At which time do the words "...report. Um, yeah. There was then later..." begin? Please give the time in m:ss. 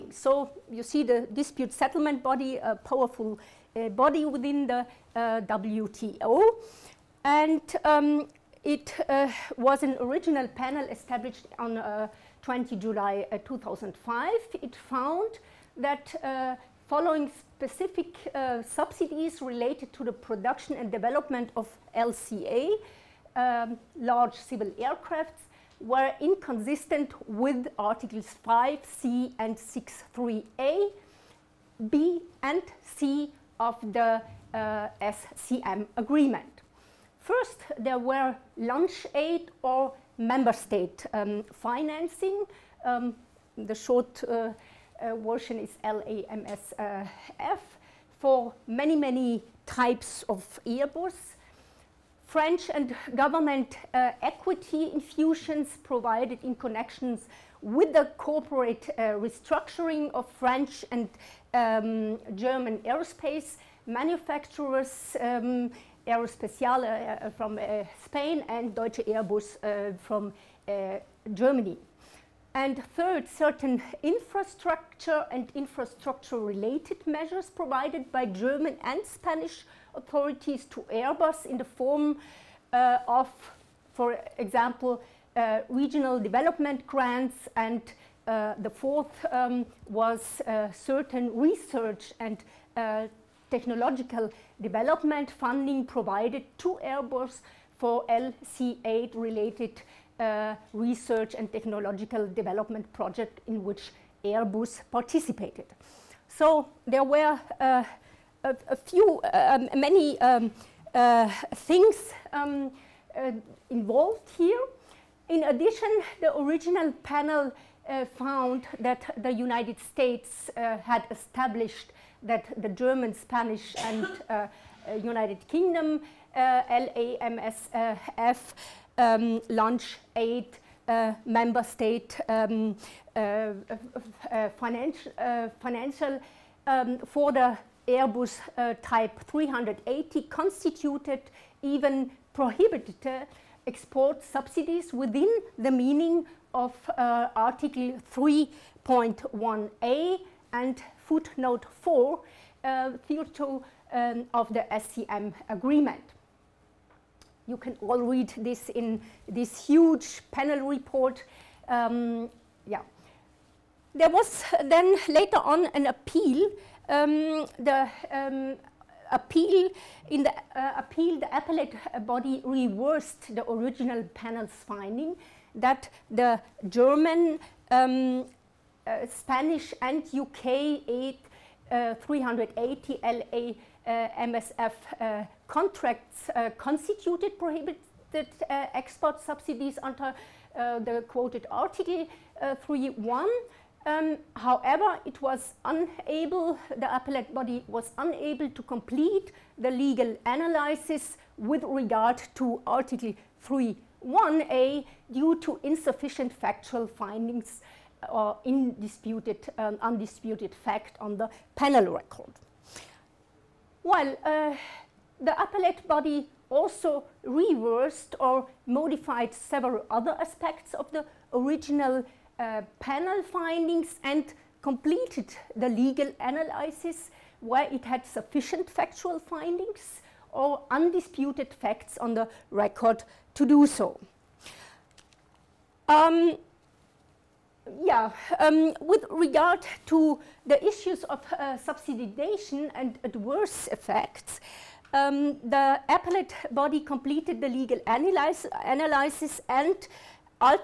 2:40.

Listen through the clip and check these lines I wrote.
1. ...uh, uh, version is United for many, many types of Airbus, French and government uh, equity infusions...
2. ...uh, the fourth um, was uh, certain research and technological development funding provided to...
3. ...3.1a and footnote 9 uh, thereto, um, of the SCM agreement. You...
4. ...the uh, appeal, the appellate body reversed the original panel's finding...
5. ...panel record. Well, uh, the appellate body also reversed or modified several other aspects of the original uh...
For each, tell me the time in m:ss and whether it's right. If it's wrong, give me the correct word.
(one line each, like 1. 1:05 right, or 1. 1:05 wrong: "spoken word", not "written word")
1. 0:44 wrong: "LAMSF", not "United"
2. 1:28 right
3. 2:28 wrong: "4", not "9"
4. 2:50 right
5. 3:31 right.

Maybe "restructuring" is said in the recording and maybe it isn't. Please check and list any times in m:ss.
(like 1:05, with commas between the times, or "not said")
0:59.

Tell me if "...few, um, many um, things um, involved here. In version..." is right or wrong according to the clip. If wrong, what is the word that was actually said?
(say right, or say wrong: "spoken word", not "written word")
wrong: "addition", not "version".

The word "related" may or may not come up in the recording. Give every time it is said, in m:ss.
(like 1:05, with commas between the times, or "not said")
0:19, 1:15, 1:39.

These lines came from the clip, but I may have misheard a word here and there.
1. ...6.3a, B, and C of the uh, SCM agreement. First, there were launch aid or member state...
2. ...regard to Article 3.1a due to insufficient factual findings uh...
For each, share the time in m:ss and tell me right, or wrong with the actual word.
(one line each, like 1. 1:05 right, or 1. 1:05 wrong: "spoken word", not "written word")
1. 0:29 right
2. 3:21 right.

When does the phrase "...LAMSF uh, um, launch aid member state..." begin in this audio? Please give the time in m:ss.
2:06.